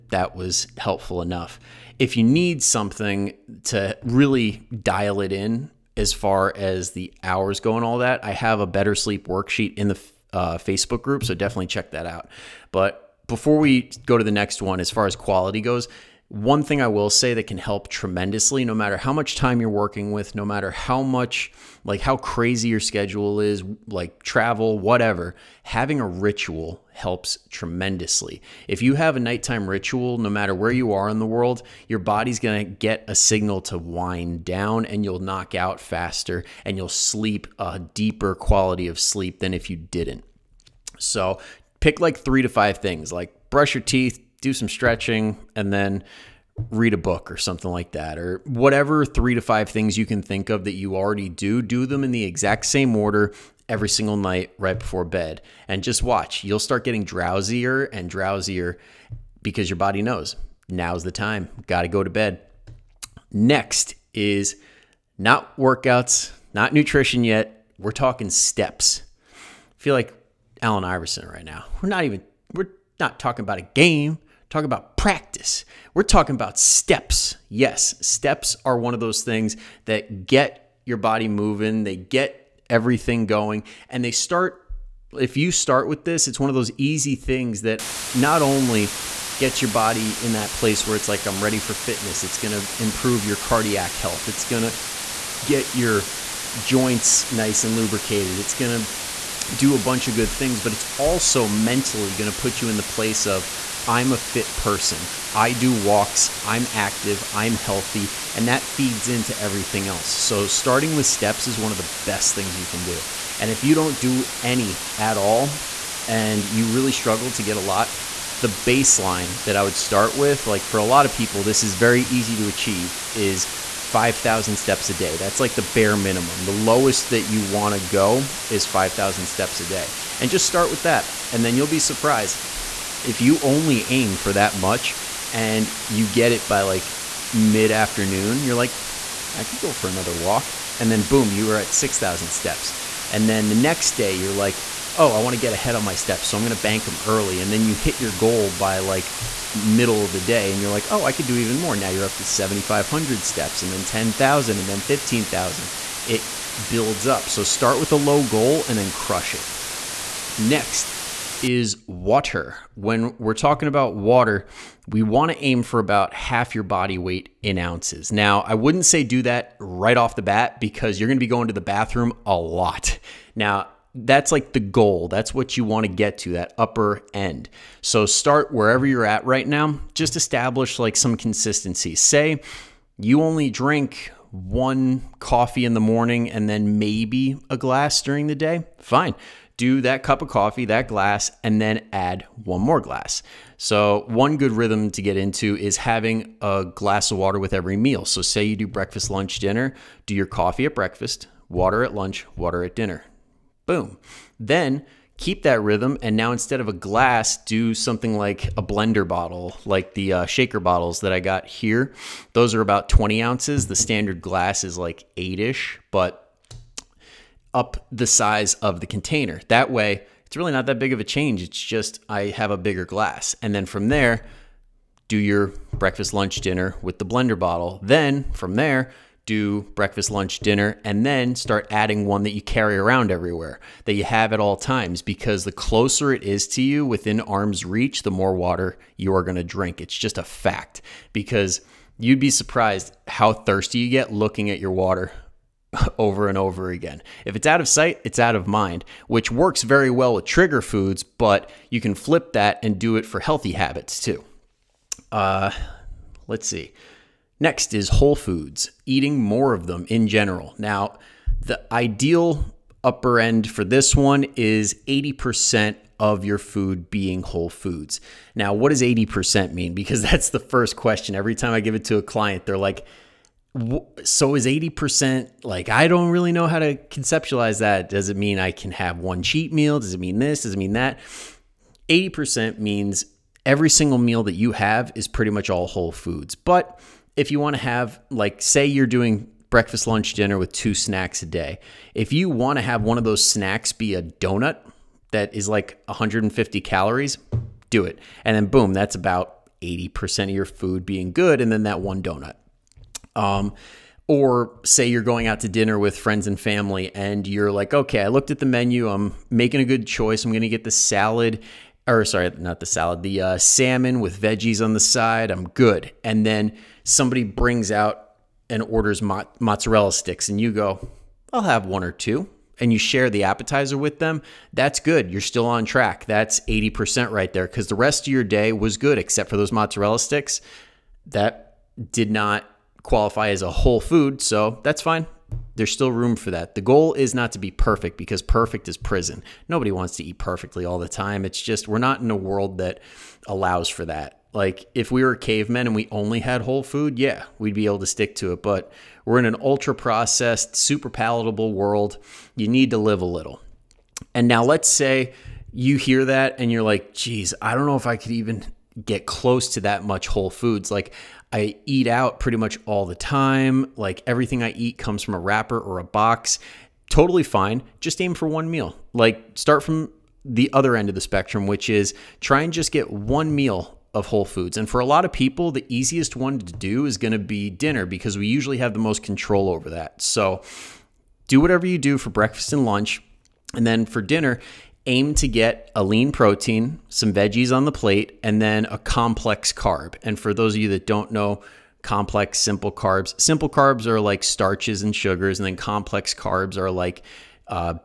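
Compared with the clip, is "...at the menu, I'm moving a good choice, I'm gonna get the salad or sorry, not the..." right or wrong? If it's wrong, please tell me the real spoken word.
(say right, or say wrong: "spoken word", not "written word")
wrong: "making", not "moving".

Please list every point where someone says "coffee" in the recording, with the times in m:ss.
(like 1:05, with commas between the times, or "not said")
3:05, 3:10, 3:20.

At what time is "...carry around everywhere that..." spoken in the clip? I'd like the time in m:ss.
3:52.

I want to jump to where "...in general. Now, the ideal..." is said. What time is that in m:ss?
4:19.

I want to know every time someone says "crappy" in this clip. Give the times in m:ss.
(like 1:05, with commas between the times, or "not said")
not said.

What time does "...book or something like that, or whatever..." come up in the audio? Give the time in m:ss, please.
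0:46.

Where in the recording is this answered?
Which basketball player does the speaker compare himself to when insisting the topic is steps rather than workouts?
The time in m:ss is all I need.
1:10.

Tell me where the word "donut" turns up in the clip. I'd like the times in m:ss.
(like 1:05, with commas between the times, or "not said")
4:54, 5:02.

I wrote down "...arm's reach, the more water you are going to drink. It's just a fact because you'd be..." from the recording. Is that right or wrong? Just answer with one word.
right.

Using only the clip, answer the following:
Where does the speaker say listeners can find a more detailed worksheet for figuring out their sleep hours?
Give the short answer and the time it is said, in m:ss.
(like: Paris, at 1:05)
Facebook group, at 0:10.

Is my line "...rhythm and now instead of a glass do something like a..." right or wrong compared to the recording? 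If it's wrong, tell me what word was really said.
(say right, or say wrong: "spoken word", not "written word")
right.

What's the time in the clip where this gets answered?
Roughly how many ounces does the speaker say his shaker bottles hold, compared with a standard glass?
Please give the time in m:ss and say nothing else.
3:32.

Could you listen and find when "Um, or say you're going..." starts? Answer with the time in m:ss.
5:03.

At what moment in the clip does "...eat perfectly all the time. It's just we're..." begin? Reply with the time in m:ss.
5:40.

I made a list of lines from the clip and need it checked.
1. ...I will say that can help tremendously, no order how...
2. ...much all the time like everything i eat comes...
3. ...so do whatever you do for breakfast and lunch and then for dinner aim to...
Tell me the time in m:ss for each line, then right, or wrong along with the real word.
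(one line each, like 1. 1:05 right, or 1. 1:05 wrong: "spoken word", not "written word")
1. 0:16 wrong: "matter", not "order"
2. 6:02 right
3. 6:20 right.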